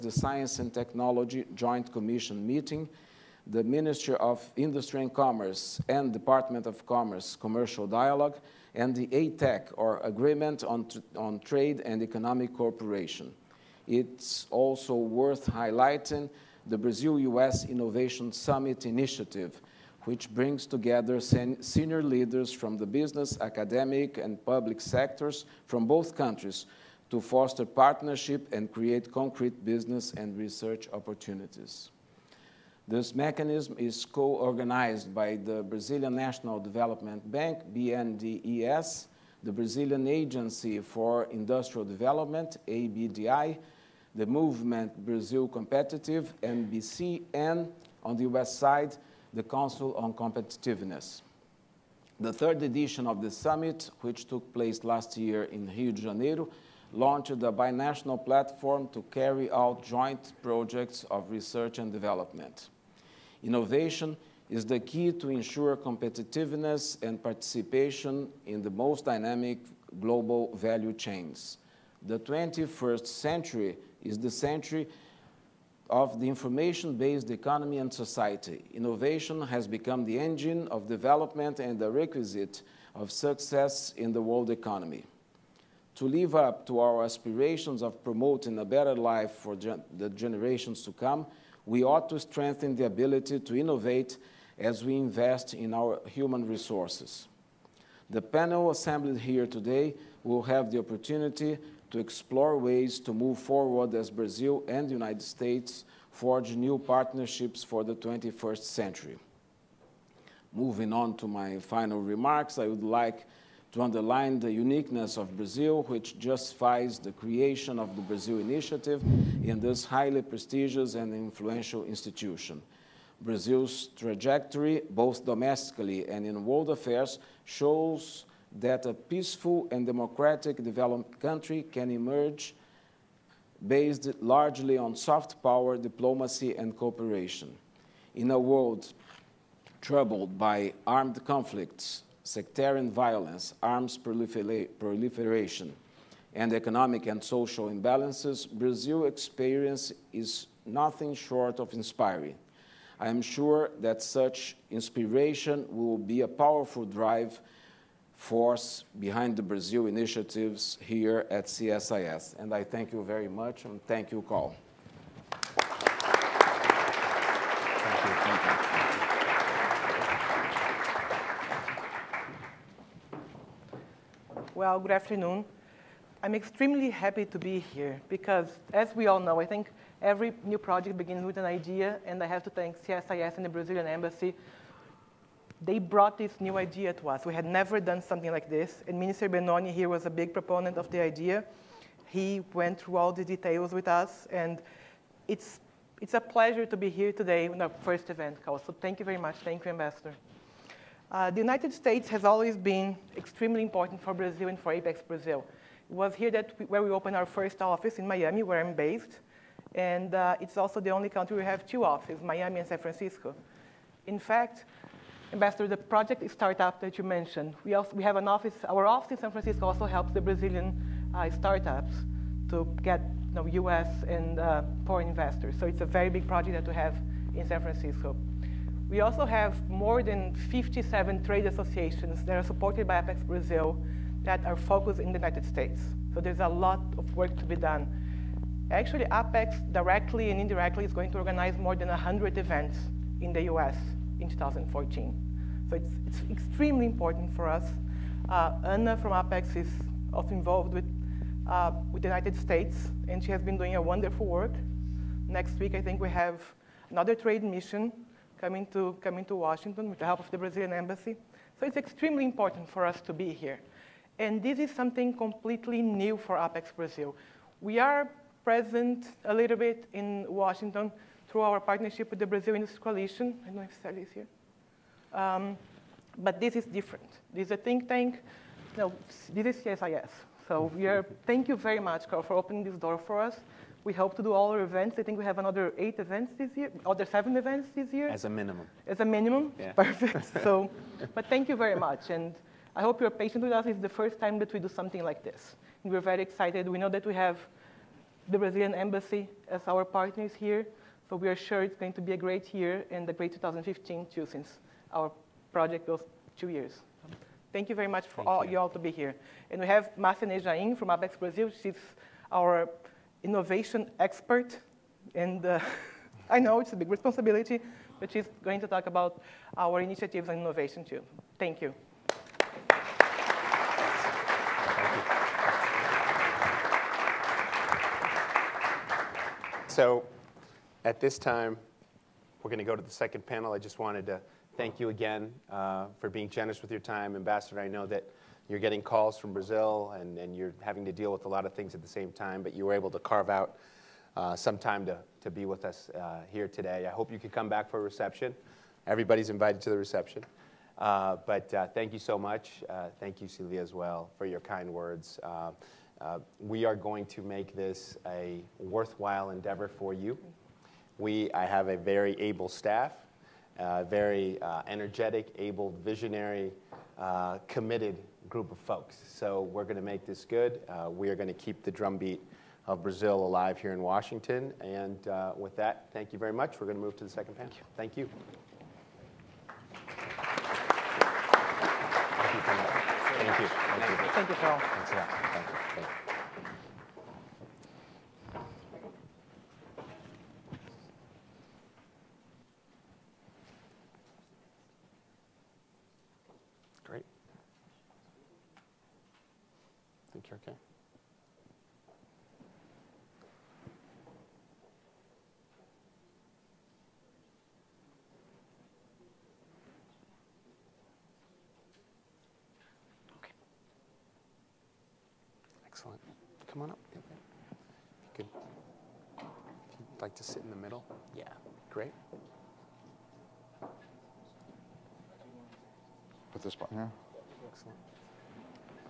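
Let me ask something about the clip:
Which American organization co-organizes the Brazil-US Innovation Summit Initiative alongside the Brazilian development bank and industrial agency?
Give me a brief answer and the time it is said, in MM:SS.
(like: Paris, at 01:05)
Council on Competitiveness, at 00:49.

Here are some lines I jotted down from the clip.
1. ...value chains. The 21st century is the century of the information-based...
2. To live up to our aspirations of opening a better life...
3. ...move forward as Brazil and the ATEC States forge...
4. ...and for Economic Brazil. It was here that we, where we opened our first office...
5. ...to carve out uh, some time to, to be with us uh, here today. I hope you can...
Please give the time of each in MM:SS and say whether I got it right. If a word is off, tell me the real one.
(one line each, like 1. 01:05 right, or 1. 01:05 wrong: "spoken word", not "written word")
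1. 01:10 right
2. 01:25 wrong: "promoting", not "opening"
3. 01:43 wrong: "United", not "ATEC"
4. 03:24 wrong: "Apex", not "Economic"
5. 05:42 right.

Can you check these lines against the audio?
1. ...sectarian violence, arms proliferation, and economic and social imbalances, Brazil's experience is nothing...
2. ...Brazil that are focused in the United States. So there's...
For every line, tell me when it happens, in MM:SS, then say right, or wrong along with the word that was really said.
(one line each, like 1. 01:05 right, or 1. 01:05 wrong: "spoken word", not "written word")
1. 02:22 right
2. 03:53 right.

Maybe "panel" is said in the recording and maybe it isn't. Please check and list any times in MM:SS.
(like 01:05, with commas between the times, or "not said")
01:38, 05:33, 06:17.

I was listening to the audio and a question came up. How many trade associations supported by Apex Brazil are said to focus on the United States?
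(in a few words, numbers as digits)
more than 57.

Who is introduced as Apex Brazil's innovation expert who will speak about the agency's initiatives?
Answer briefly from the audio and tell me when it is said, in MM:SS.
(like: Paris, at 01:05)
Marcia Nejaim, at 05:09.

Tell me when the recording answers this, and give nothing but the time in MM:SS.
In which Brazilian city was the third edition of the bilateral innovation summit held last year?
00:55.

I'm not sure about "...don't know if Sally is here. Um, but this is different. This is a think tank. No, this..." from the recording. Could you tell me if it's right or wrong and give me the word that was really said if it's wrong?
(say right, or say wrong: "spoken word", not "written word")
right.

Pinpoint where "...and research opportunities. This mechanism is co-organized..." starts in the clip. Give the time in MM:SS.
00:30.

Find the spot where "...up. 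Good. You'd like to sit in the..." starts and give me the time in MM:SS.
06:56.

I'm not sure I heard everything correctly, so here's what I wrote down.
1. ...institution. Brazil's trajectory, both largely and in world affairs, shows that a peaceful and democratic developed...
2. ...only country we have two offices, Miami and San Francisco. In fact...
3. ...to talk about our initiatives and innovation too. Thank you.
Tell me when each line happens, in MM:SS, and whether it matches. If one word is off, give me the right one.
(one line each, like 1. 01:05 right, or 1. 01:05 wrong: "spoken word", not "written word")
1. 02:01 wrong: "domestically", not "largely"
2. 03:30 right
3. 05:18 right.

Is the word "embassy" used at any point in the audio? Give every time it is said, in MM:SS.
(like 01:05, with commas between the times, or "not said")
03:03, 04:20, 04:58.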